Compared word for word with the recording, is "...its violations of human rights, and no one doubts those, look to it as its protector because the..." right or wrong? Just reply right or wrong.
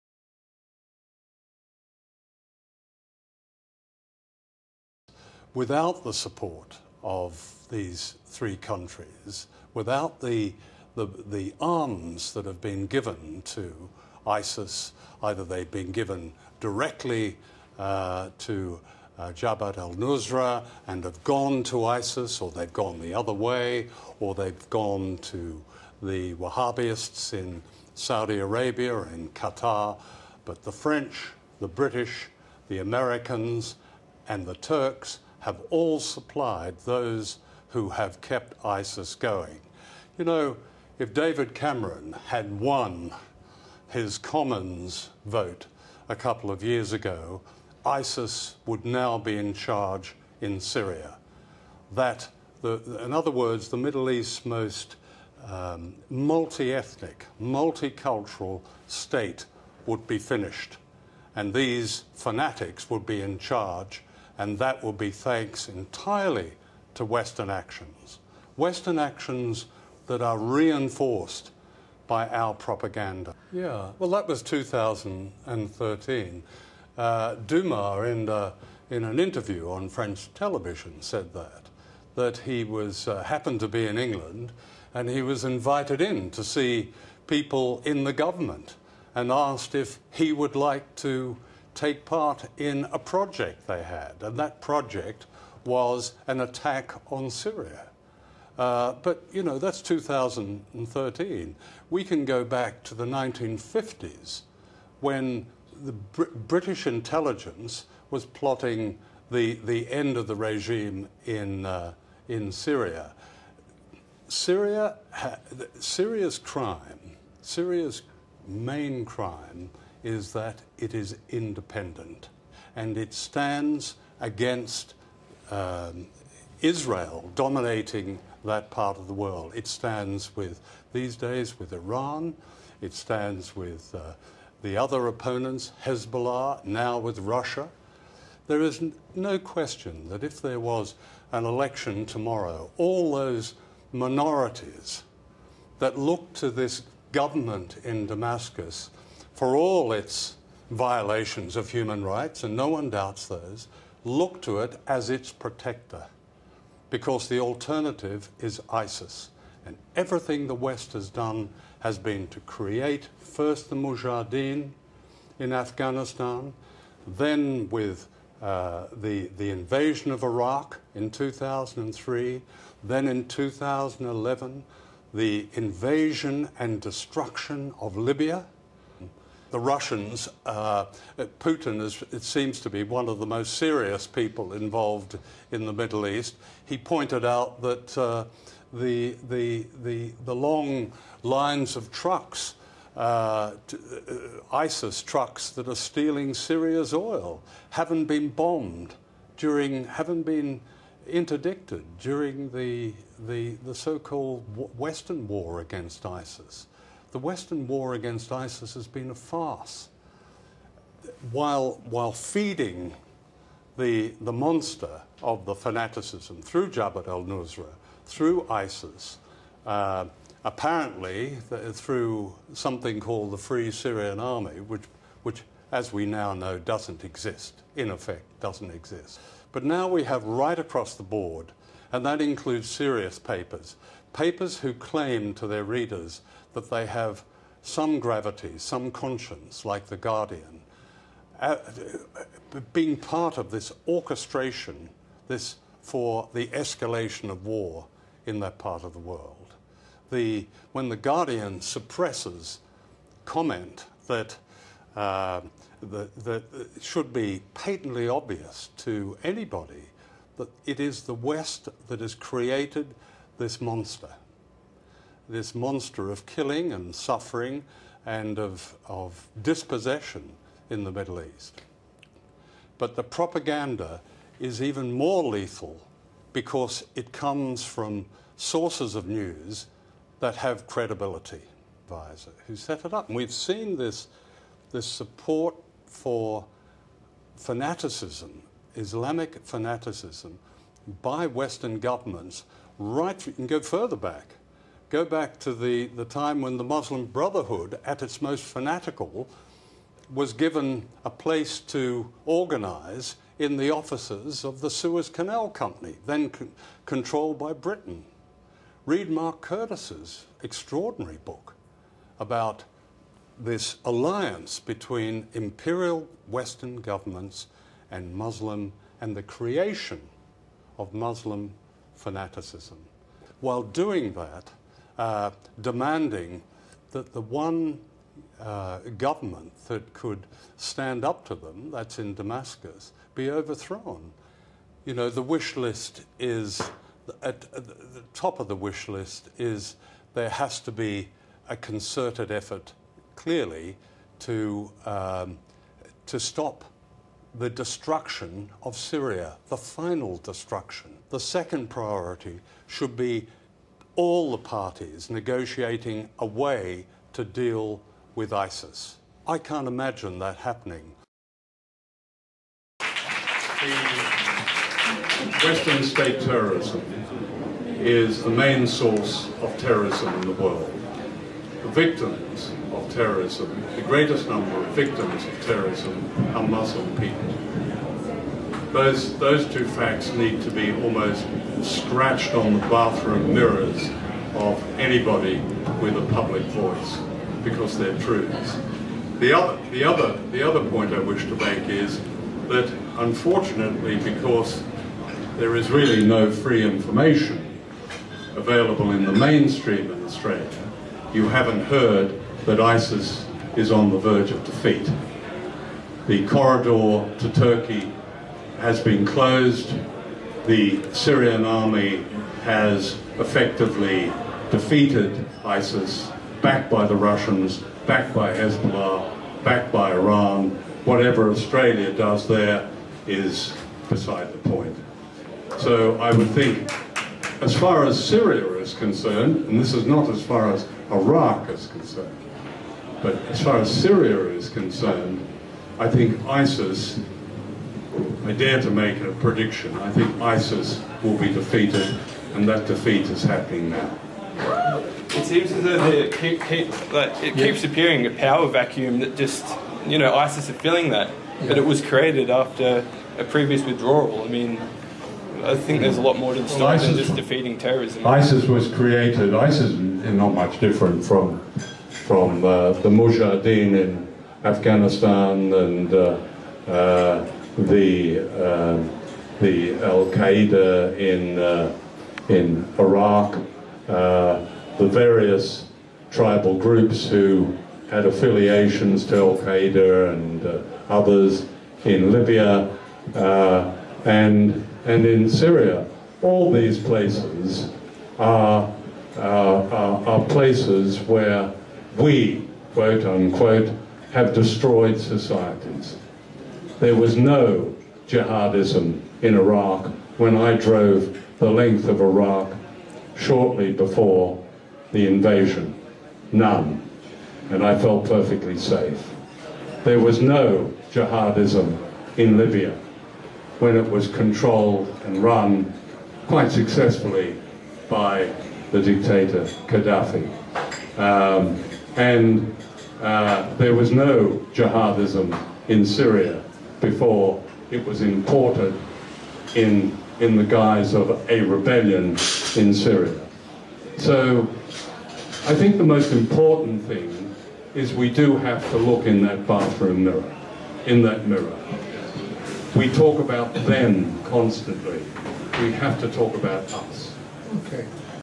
right.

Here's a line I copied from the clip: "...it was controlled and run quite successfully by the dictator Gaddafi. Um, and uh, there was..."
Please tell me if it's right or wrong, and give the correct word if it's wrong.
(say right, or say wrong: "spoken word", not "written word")
right.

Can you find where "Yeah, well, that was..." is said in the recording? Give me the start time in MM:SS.
01:13.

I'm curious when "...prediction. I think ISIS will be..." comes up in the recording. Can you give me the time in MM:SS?
07:19.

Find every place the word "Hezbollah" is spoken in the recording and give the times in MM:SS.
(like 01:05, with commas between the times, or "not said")
02:15, 06:58.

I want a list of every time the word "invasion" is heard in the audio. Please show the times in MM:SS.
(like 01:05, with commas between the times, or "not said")
02:49, 02:55, 08:25.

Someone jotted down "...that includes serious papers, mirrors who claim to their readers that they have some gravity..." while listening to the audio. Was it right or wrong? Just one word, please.
wrong.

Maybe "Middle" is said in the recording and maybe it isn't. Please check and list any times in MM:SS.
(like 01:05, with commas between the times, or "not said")
00:53, 03:05, 04:30.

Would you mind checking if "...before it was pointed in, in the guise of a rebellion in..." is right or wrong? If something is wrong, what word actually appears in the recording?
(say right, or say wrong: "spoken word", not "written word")
wrong: "imported", not "pointed".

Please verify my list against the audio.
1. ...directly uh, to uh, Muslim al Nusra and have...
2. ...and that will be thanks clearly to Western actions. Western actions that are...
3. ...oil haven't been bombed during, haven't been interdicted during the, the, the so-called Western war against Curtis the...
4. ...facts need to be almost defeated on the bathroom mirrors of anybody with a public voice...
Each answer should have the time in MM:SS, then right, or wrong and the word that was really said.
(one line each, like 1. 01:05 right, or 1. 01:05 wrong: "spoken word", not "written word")
1. 00:16 wrong: "Jabhat", not "Muslim"
2. 01:04 wrong: "entirely", not "clearly"
3. 03:16 wrong: "ISIS", not "Curtis"
4. 06:19 wrong: "scratched", not "defeated".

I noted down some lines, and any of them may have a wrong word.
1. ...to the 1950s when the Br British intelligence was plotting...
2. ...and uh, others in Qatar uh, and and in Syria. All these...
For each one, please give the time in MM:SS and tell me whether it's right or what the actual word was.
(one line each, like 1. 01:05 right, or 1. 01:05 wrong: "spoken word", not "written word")
1. 01:42 right
2. 08:00 wrong: "Libya", not "Qatar".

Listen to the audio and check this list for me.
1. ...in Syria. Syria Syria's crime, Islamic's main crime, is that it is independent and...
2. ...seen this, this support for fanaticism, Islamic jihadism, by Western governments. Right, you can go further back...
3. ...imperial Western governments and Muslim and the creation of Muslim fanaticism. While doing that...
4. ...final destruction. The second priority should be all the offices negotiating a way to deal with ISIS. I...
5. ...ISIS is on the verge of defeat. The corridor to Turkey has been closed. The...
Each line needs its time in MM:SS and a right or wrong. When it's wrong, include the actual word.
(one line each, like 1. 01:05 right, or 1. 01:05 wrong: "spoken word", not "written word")
1. 01:52 wrong: "Syria", not "Islamic"
2. 04:43 wrong: "fanaticism", not "jihadism"
3. 05:15 right
4. 05:49 wrong: "parties", not "offices"
5. 06:42 right.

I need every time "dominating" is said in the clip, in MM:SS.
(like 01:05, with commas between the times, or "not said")
02:07.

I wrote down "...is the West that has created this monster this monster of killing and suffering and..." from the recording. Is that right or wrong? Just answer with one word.
right.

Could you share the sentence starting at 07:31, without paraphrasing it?
But it was created after a previous withdrawal.